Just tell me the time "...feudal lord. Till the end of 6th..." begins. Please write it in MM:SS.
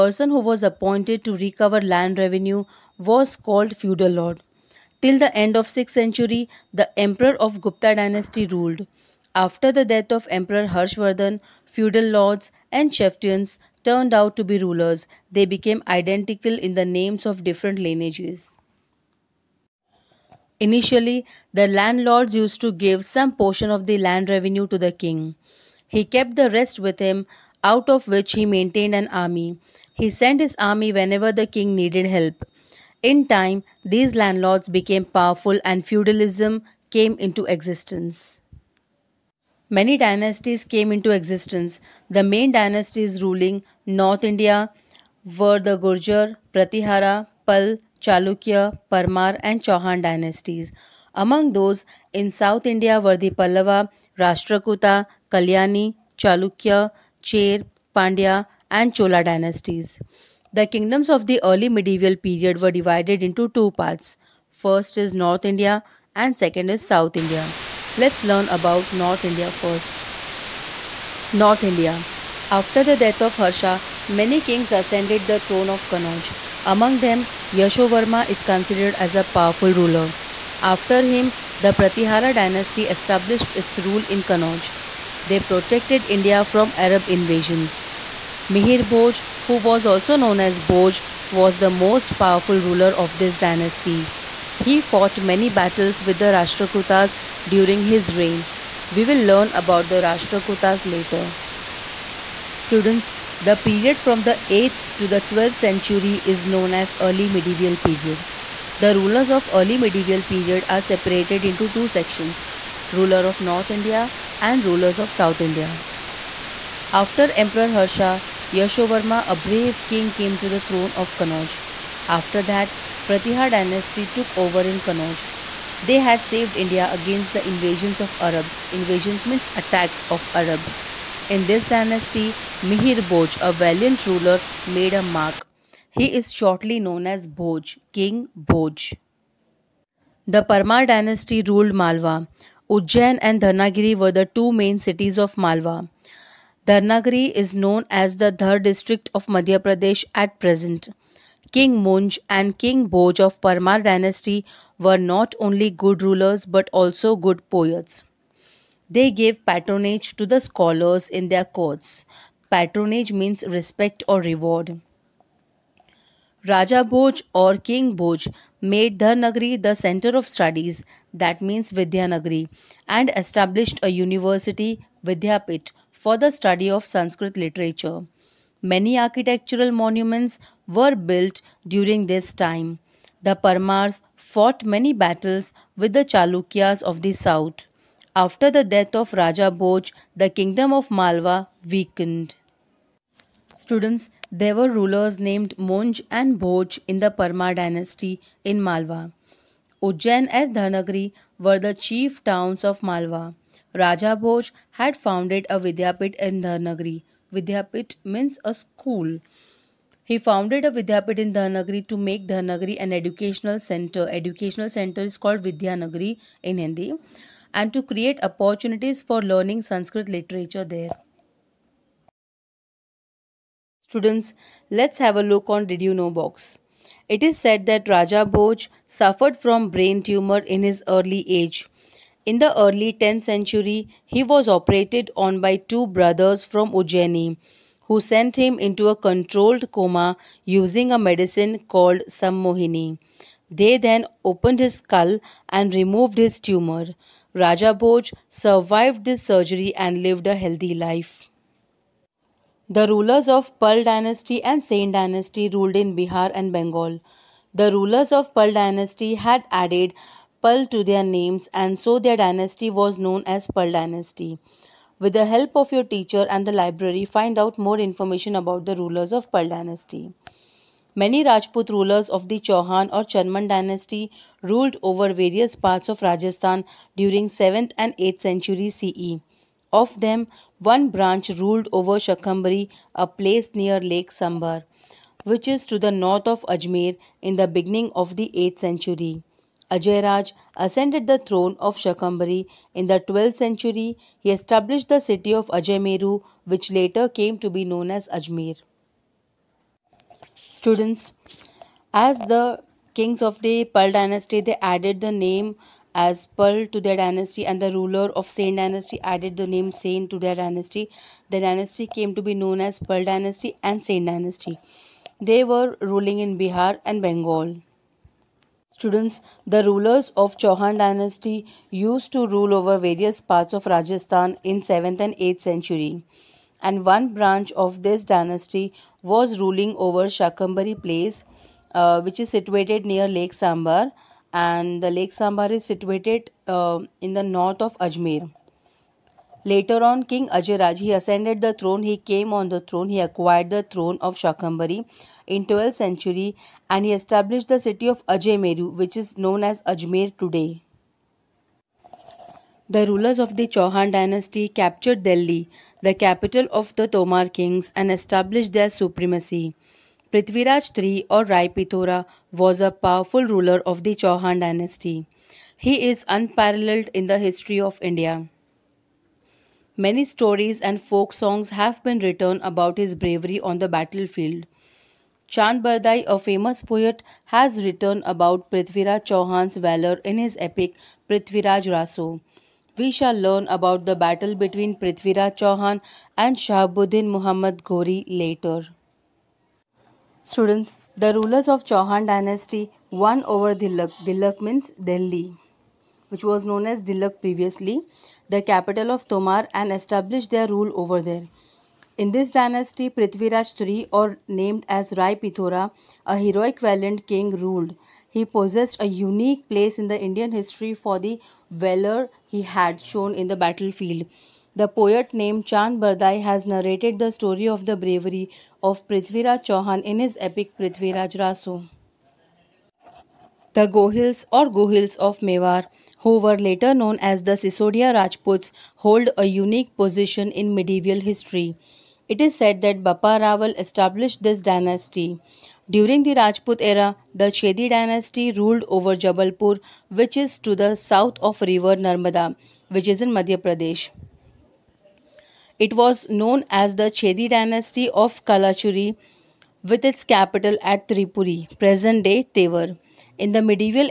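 00:03.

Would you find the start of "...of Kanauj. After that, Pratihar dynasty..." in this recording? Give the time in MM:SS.
02:00.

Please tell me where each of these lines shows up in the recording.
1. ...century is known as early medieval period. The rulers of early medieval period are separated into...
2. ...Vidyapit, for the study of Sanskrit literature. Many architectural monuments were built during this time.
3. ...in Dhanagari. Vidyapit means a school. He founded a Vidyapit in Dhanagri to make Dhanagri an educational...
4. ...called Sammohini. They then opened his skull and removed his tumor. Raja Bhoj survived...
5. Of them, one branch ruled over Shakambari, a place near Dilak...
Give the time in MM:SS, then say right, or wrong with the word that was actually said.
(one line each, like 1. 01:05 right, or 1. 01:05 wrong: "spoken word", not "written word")
1. 01:45 right
2. 02:55 right
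3. 03:26 right
4. 04:01 right
5. 04:39 wrong: "Lake", not "Dilak".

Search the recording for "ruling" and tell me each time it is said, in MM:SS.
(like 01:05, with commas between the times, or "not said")
00:43, 05:15, 05:29.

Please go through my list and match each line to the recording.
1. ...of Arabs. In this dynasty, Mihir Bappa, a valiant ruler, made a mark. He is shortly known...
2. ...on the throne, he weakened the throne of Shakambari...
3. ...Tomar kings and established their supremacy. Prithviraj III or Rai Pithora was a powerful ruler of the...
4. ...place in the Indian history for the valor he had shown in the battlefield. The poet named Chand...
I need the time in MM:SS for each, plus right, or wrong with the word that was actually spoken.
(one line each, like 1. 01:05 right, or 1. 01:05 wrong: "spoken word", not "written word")
1. 02:10 wrong: "Bhoj", not "Bappa"
2. 05:42 wrong: "acquired", not "weakened"
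3. 05:56 right
4. 06:49 right.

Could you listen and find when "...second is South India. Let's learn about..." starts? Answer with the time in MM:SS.
01:06.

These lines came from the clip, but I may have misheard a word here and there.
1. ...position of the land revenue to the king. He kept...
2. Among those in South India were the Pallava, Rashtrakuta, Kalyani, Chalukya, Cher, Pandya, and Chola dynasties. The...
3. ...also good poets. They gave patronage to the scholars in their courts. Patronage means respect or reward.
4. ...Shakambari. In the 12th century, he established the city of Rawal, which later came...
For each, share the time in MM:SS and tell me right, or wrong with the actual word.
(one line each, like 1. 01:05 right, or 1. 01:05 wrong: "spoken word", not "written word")
1. 00:23 wrong: "portion", not "position"
2. 00:51 right
3. 02:36 right
4. 04:51 wrong: "Ajmeru", not "Rawal".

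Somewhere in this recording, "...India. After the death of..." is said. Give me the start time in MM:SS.
01:11.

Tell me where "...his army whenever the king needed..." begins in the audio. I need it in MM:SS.
00:30.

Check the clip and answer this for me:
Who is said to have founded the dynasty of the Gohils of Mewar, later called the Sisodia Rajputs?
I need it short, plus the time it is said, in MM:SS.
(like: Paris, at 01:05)
Bappa Rawal, at 07:12.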